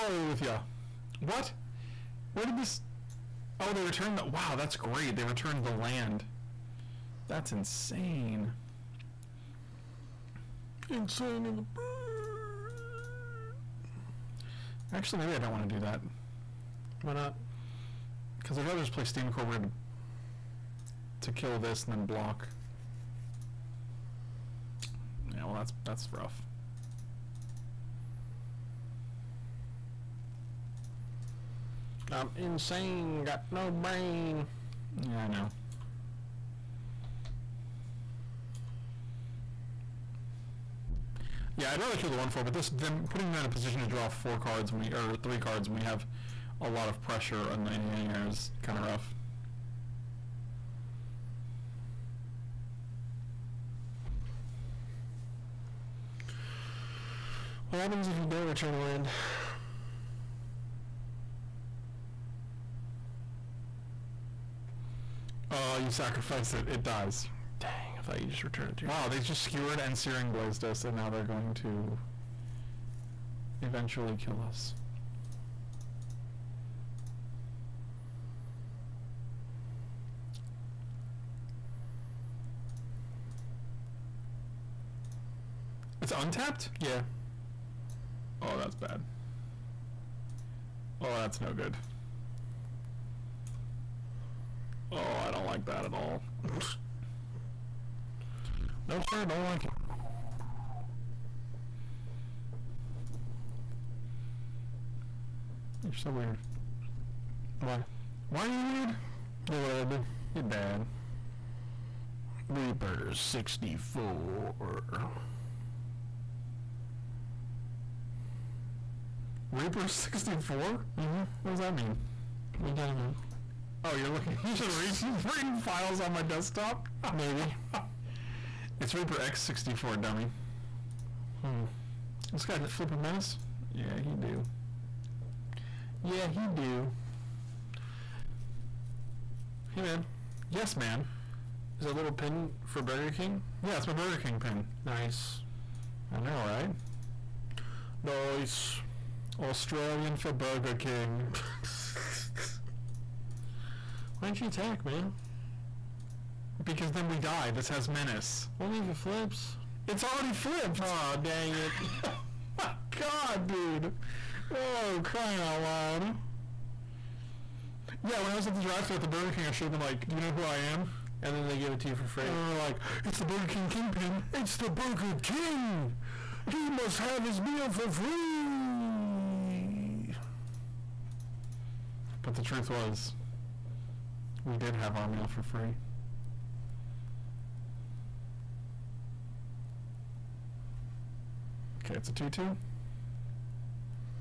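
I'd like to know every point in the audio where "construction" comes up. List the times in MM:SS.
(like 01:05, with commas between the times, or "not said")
not said.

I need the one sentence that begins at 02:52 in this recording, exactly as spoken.
And then they're like, "It's the Burger King kingpin." It's the Burger King.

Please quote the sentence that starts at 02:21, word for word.
Is that little pin for Burger King?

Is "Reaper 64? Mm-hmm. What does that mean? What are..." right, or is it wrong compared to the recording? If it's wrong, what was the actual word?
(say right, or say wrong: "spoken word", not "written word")
right.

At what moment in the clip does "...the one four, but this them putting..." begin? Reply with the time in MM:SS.
00:42.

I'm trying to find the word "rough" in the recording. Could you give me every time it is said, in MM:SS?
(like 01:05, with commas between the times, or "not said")
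00:26, 00:48.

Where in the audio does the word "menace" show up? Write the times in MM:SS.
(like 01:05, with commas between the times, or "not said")
02:12, 02:37.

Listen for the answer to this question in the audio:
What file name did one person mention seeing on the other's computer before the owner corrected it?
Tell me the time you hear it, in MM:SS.
02:08.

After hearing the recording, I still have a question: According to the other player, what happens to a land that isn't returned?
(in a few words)
You sacrifice it.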